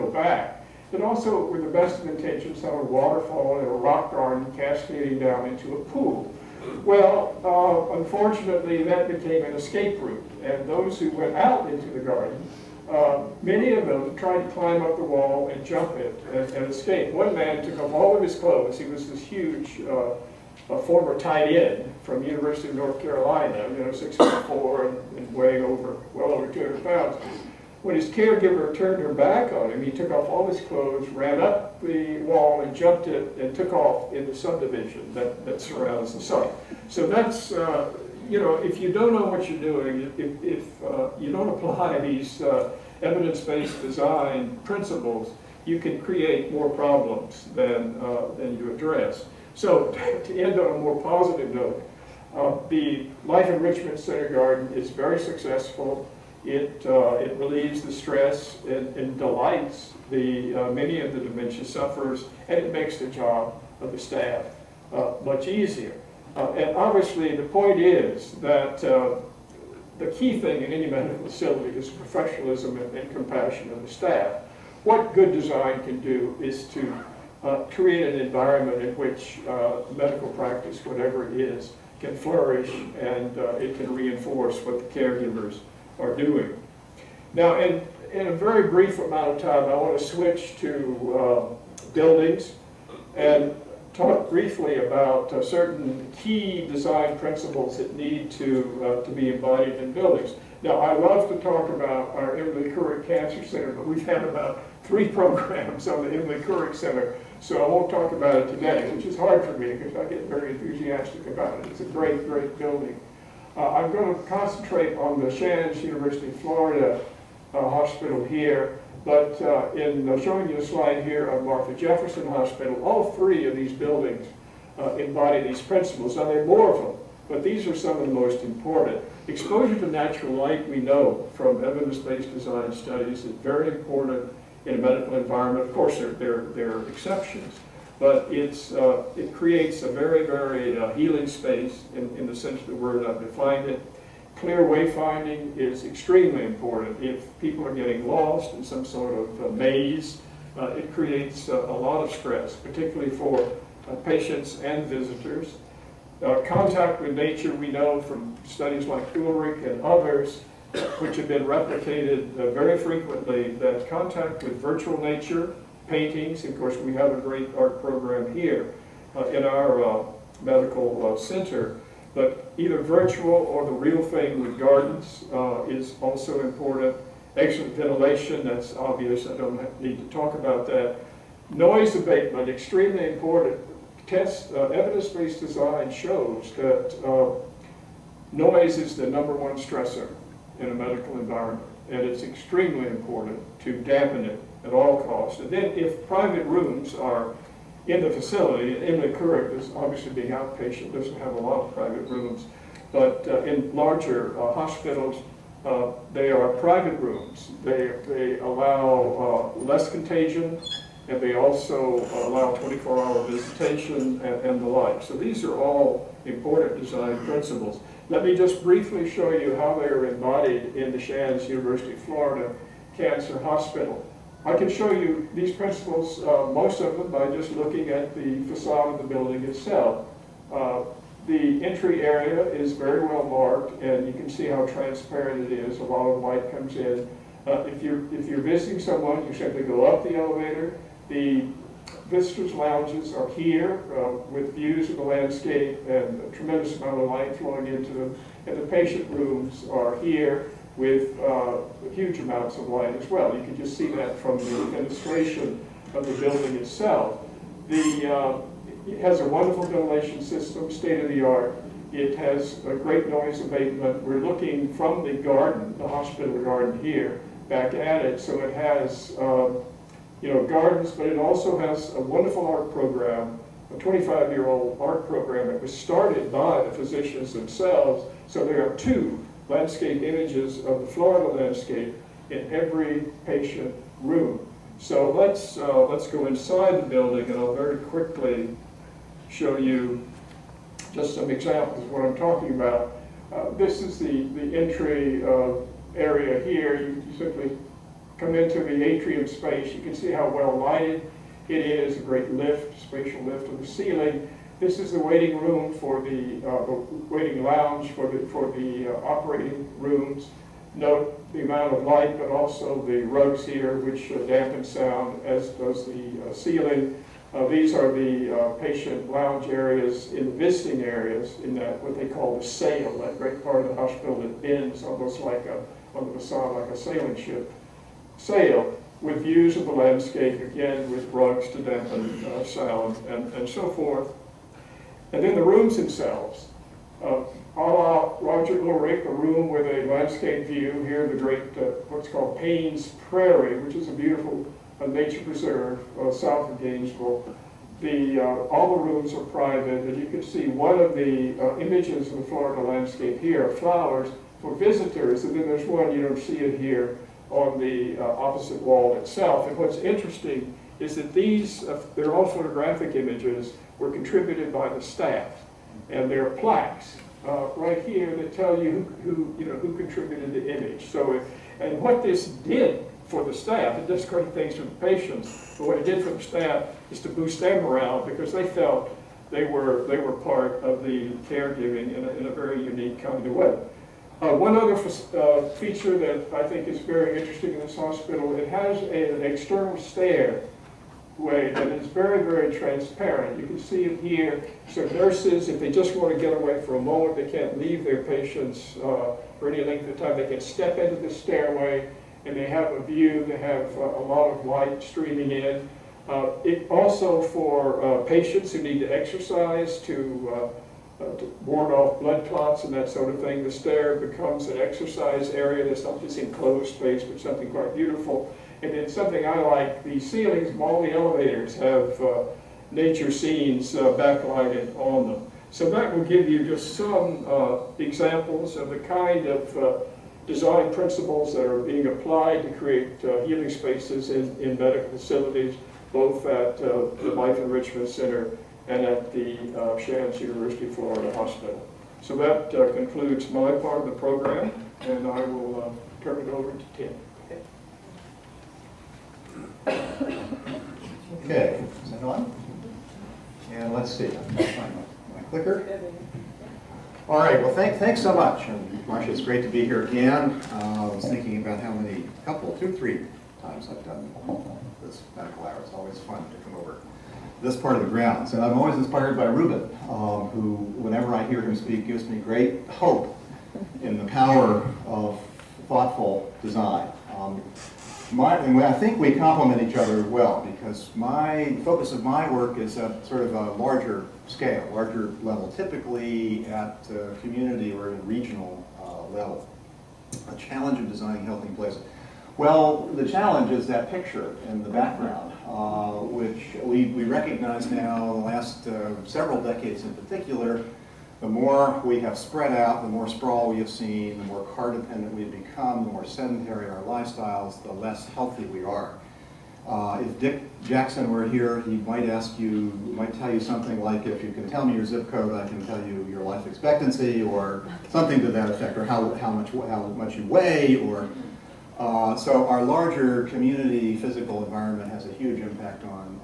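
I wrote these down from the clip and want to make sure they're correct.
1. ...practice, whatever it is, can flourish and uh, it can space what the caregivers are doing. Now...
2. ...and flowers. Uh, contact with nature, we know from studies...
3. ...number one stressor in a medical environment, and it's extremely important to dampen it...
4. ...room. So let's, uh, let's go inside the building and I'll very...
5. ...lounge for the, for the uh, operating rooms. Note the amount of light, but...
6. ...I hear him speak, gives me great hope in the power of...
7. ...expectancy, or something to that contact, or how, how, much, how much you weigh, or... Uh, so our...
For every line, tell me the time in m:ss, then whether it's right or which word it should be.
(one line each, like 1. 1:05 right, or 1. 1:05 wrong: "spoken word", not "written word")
1. 1:20 wrong: "reinforce", not "space"
2. 2:34 wrong: "visitors", not "flowers"
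3. 3:09 right
4. 4:44 right
5. 5:07 right
6. 7:51 right
7. 8:36 wrong: "effect", not "contact".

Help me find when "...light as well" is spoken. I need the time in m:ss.
4:12.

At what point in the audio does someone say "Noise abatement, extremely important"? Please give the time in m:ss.
3:01.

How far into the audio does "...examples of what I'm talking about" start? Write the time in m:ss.
4:51.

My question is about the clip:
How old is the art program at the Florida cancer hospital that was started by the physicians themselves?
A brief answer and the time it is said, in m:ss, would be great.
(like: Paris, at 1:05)
25 years, at 4:33.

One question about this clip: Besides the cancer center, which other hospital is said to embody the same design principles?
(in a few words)
Martha Jefferson Hospital.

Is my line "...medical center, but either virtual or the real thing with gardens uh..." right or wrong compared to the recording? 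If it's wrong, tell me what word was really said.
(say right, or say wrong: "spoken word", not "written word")
right.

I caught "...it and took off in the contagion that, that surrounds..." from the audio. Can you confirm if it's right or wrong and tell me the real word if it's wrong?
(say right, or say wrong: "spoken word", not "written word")
wrong: "subdivision", not "contagion".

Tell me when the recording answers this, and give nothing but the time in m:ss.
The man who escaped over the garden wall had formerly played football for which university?
0:22.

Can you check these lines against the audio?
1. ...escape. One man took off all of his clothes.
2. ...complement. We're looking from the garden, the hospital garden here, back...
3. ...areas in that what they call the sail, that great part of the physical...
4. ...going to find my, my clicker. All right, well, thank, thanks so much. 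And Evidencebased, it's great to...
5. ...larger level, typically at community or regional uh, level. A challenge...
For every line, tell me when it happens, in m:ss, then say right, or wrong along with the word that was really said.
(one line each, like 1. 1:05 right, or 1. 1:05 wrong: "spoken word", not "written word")
1. 0:16 right
2. 4:23 wrong: "abatement", not "complement"
3. 5:20 wrong: "hospital", not "physical"
4. 7:34 wrong: "Marcia", not "Evidencebased"
5. 8:04 right.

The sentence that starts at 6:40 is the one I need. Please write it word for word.
They can step into the stairway and they have a view.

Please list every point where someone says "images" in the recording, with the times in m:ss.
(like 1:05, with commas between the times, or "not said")
4:40, 5:51, 6:02, 6:10.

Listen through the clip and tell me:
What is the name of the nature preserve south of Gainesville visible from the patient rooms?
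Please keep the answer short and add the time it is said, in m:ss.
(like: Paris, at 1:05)
Payne's Prairie, at 5:42.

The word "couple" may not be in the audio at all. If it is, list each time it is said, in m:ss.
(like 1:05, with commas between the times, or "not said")
7:42.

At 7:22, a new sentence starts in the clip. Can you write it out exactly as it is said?
So that concludes my part of the program, and I will turn it over to Tim.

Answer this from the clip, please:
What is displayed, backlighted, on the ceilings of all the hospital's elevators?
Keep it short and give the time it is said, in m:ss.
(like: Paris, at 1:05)
Nature scenes, at 7:02.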